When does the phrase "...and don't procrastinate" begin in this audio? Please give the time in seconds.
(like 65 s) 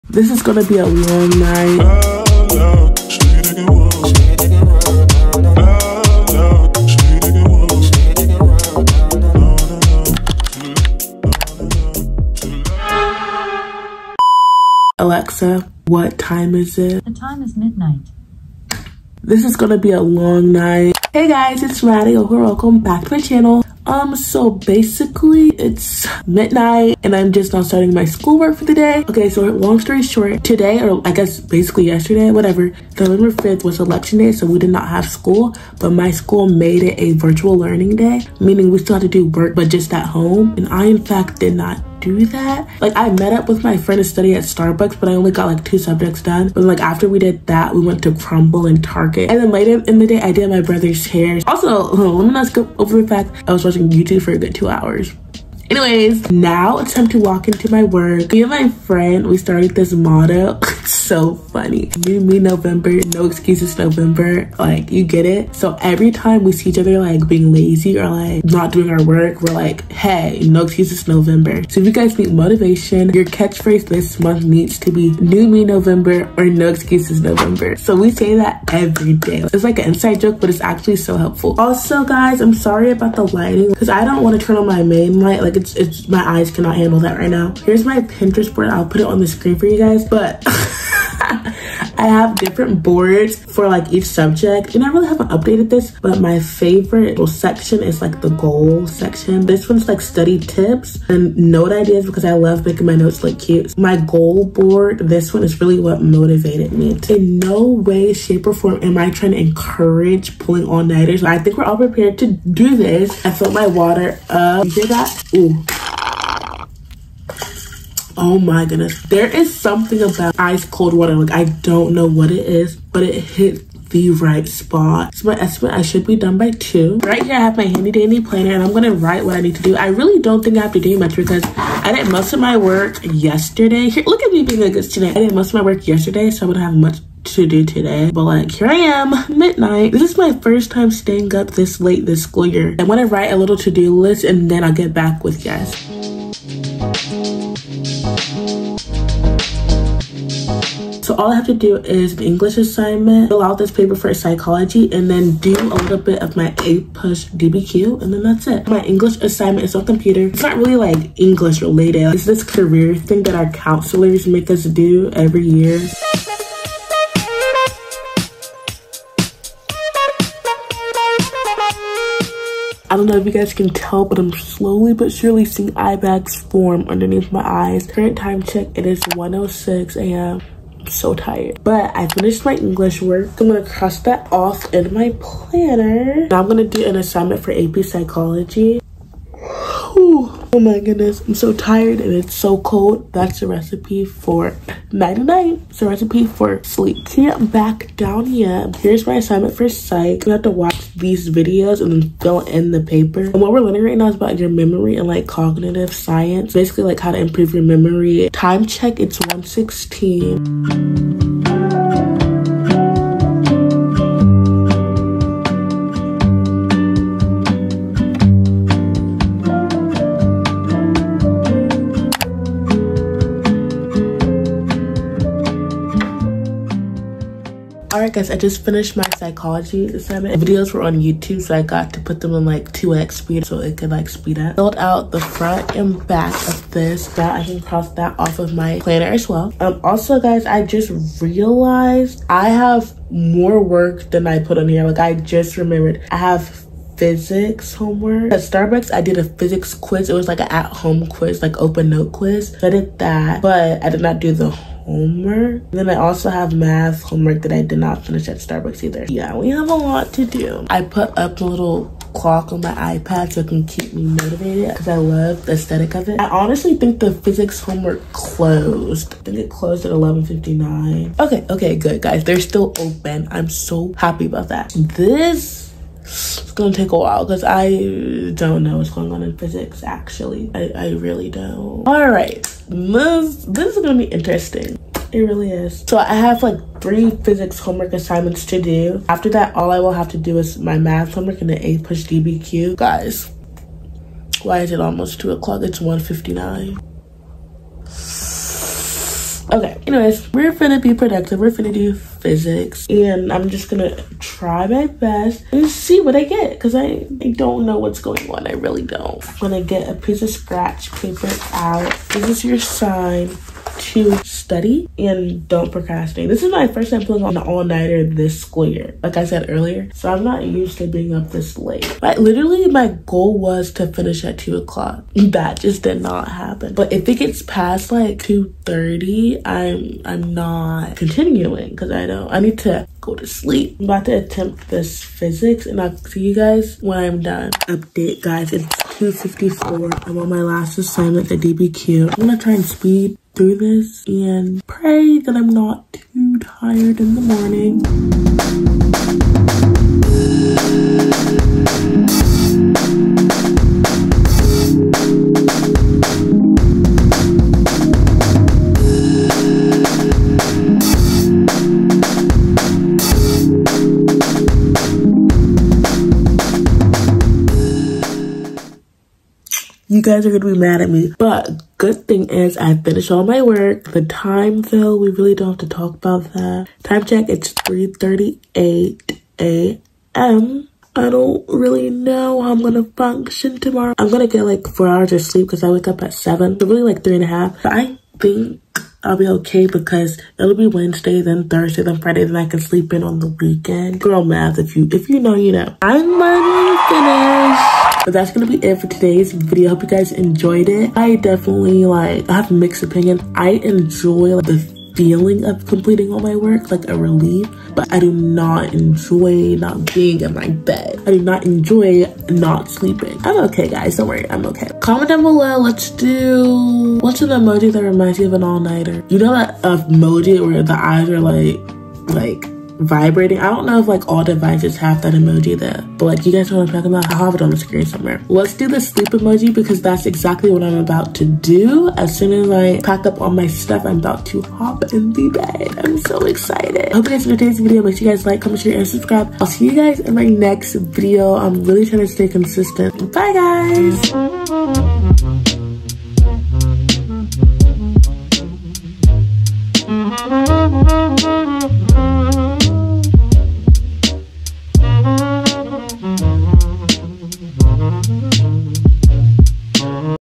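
314 s.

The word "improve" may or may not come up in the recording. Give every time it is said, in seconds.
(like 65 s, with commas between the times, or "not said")
207 s.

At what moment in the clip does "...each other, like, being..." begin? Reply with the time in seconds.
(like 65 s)
66 s.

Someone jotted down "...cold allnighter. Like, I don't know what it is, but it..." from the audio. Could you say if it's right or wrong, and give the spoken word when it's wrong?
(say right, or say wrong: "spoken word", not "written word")
wrong: "water", not "allnighter".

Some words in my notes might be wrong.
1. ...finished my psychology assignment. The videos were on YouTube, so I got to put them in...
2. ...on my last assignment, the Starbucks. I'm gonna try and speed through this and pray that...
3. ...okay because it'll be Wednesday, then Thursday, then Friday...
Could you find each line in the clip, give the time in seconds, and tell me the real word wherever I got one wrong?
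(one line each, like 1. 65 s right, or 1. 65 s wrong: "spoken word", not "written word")
1. 228 s right
2. 340 s wrong: "DBQ", not "Starbucks"
3. 389 s right.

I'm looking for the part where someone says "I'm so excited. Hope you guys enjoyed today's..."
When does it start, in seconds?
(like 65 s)
435 s.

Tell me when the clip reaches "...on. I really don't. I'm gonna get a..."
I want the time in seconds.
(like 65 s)
308 s.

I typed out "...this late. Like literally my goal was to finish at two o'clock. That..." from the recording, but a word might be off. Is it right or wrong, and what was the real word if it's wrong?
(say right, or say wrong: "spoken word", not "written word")
right.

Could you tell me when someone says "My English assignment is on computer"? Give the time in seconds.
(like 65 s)
158 s.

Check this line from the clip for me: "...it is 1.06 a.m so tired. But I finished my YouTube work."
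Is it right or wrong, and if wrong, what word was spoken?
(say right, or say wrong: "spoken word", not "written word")
wrong: "English", not "YouTube".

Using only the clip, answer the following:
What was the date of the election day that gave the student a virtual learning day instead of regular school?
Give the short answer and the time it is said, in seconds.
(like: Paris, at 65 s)
November 5th, at 32 s.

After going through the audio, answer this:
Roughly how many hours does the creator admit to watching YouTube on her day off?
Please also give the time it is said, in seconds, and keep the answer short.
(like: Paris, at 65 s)
2, at 54 s.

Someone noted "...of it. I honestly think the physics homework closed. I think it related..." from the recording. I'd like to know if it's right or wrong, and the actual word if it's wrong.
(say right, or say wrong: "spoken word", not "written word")
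wrong: "closed", not "related".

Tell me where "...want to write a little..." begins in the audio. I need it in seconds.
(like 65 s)
142 s.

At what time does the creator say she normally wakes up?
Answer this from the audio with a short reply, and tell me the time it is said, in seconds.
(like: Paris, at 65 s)
7, at 386 s.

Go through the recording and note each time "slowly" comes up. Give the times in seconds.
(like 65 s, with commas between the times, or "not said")
174 s.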